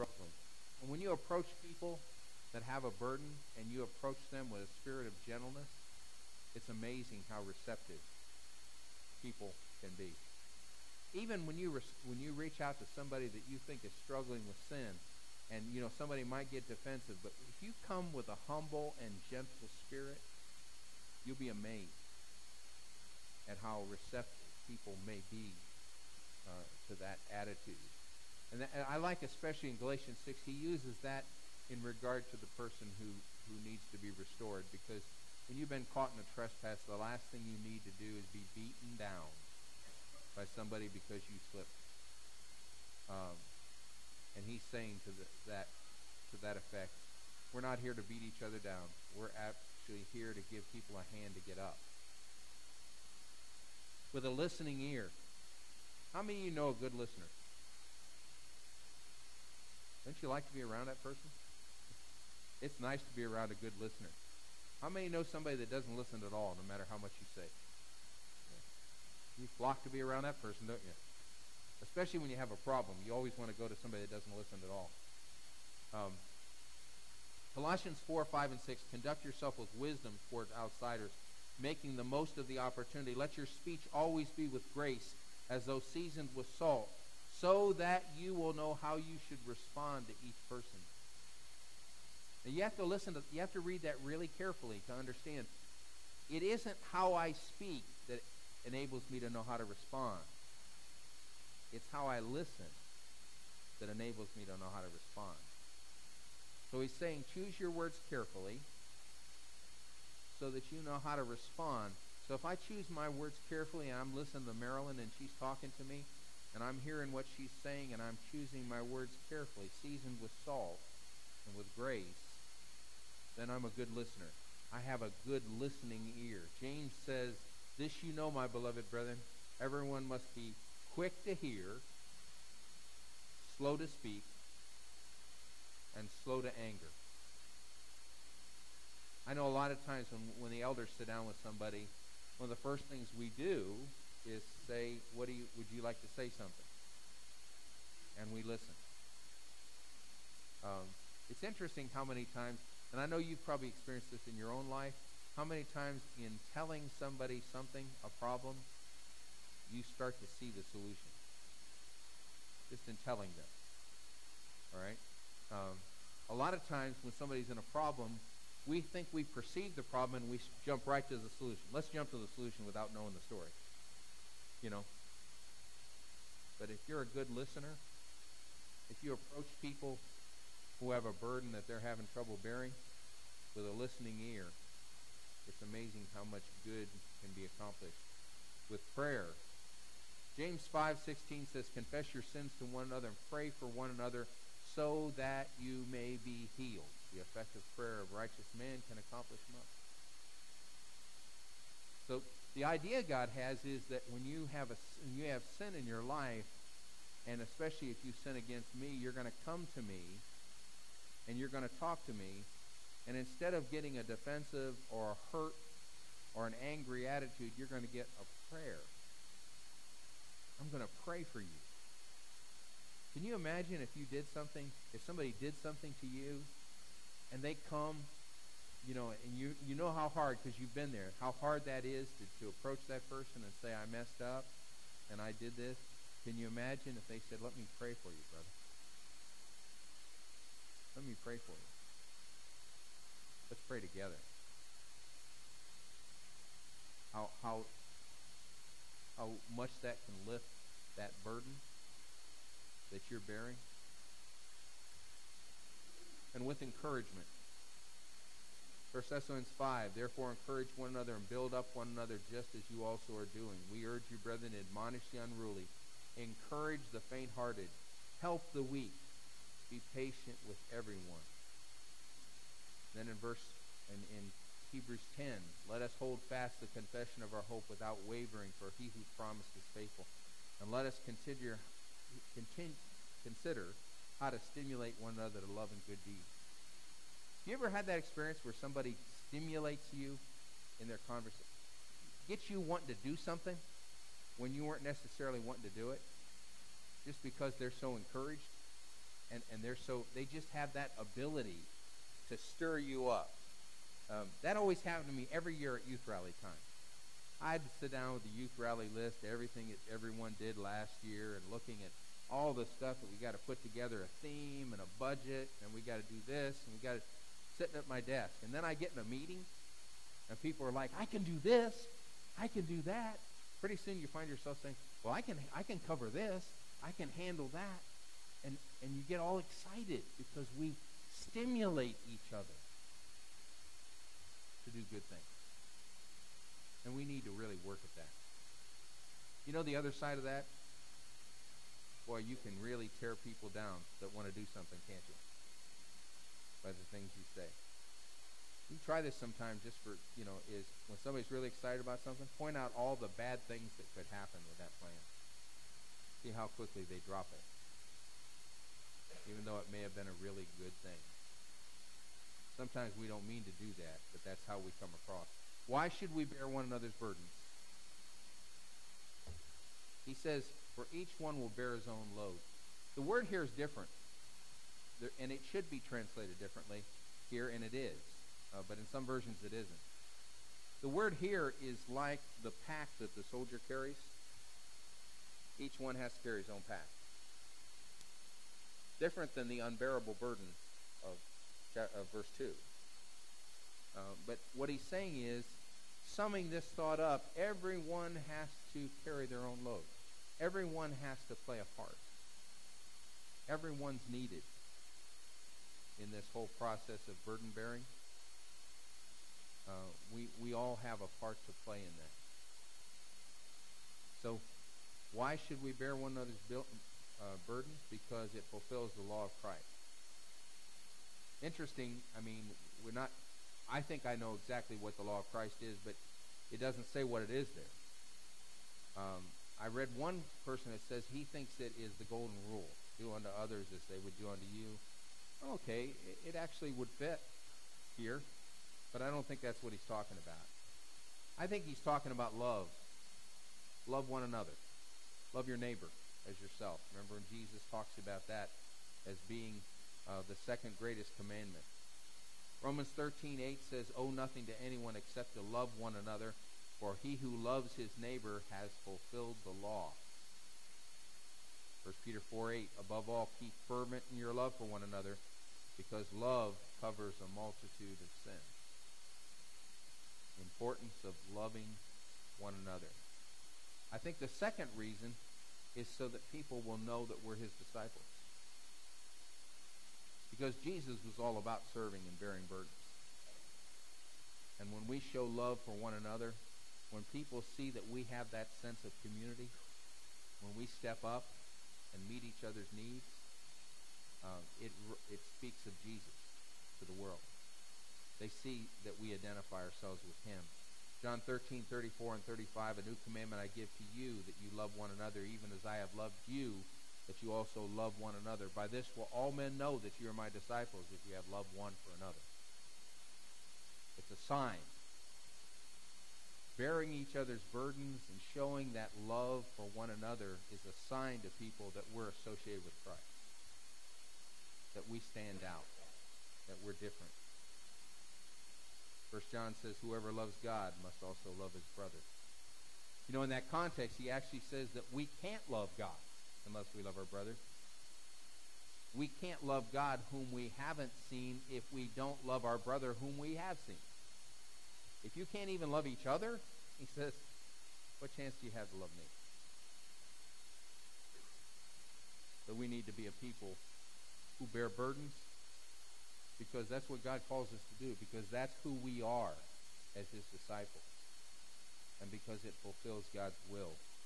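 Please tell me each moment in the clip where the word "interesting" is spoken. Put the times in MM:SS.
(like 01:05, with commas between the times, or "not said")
02:31, 07:01.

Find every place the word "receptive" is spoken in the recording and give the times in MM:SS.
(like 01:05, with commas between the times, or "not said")
00:07, 00:23.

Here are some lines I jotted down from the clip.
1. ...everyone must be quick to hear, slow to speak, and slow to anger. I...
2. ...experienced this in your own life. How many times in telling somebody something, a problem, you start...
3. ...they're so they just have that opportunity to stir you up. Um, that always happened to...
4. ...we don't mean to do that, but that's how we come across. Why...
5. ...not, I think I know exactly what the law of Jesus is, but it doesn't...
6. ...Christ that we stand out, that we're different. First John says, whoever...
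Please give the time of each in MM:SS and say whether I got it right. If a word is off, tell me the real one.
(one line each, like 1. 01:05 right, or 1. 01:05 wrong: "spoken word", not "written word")
1. 02:09 right
2. 02:33 right
3. 04:59 wrong: "ability", not "opportunity"
4. 06:02 right
5. 07:02 wrong: "Christ", not "Jesus"
6. 08:42 right.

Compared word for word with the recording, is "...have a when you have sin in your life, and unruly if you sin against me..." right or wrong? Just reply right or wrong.
wrong.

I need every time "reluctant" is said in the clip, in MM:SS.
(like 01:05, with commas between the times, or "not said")
not said.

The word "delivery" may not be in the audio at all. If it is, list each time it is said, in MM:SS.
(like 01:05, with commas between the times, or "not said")
not said.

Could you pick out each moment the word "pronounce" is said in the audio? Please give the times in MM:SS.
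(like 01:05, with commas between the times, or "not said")
not said.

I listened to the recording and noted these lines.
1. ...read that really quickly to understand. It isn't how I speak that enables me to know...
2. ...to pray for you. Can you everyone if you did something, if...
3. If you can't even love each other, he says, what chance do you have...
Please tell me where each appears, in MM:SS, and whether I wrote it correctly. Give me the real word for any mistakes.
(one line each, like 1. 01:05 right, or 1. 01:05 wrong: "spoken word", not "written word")
1. 01:33 wrong: "carefully", not "quickly"
2. 03:40 wrong: "imagine", not "everyone"
3. 09:05 right.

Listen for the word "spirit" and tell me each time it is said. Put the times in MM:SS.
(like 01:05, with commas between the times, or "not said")
00:04, 00:19.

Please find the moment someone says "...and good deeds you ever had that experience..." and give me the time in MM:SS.
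04:45.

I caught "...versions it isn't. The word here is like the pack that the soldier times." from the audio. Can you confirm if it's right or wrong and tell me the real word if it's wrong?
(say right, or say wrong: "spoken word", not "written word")
wrong: "carries", not "times".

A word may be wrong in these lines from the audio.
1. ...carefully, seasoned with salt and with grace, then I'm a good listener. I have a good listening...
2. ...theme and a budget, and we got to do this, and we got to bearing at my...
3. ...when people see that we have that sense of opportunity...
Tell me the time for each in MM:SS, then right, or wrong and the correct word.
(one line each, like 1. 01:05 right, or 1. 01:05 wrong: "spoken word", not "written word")
1. 01:59 right
2. 05:14 wrong: "sitting", not "bearing"
3. 08:06 wrong: "community", not "opportunity".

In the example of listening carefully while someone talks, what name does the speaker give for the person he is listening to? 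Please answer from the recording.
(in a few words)
Marilyn.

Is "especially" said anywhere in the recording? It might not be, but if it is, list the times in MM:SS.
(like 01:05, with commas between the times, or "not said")
00:29, 01:11, 03:27.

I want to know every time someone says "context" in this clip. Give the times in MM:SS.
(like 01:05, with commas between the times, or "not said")
08:53.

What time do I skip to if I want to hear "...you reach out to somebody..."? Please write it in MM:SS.
00:12.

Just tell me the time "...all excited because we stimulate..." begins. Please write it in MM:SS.
05:29.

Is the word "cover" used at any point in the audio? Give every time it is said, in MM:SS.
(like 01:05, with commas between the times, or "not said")
05:25, 07:46.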